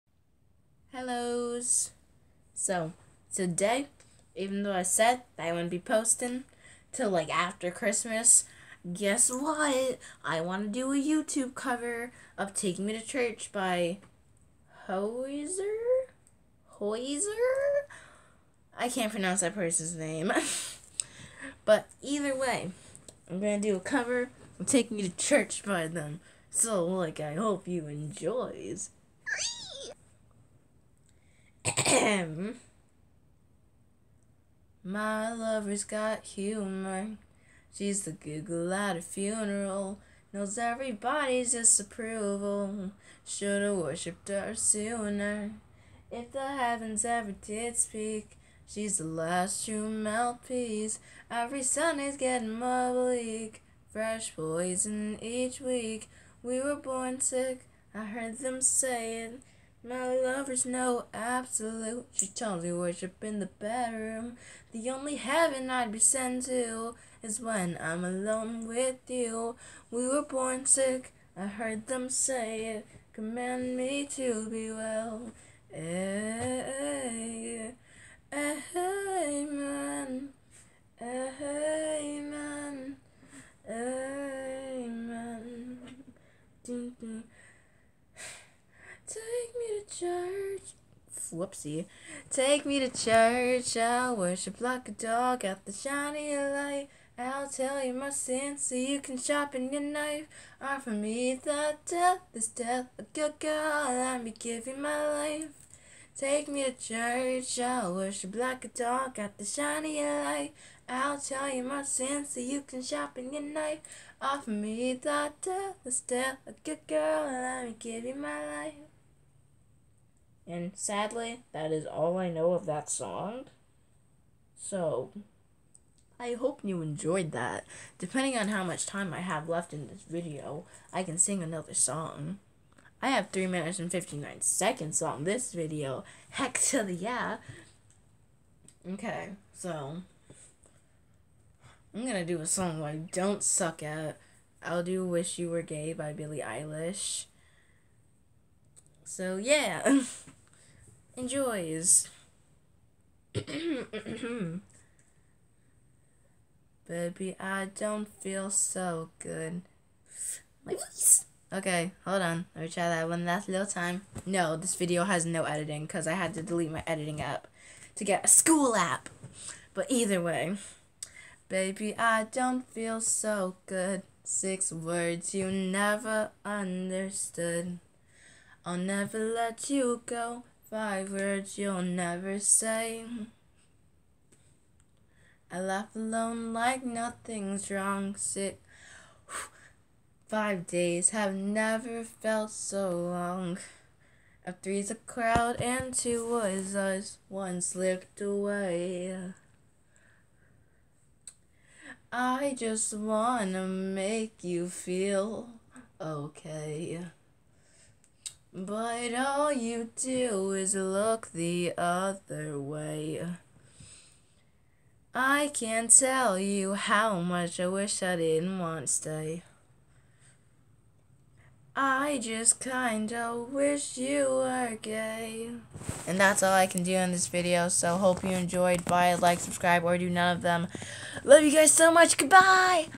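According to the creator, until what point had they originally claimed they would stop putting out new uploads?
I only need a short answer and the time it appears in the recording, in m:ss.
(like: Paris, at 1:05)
after Christmas, at 0:07.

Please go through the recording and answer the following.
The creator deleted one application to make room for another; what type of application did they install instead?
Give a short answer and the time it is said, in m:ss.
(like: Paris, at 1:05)
school app, at 2:48.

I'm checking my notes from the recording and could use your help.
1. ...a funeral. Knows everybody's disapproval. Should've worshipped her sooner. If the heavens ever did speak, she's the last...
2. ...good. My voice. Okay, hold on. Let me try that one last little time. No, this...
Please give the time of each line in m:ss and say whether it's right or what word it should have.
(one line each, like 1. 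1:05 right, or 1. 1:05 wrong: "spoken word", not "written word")
1. 0:38 right
2. 2:39 right.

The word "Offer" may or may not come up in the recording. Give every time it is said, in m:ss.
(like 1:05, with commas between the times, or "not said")
1:40, 1:54.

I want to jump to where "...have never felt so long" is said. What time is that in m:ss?
3:11.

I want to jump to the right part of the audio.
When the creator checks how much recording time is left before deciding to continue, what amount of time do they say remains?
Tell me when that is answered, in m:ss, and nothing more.
2:13.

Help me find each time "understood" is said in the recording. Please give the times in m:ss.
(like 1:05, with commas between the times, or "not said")
2:56.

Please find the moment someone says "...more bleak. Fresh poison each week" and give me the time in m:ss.
0:52.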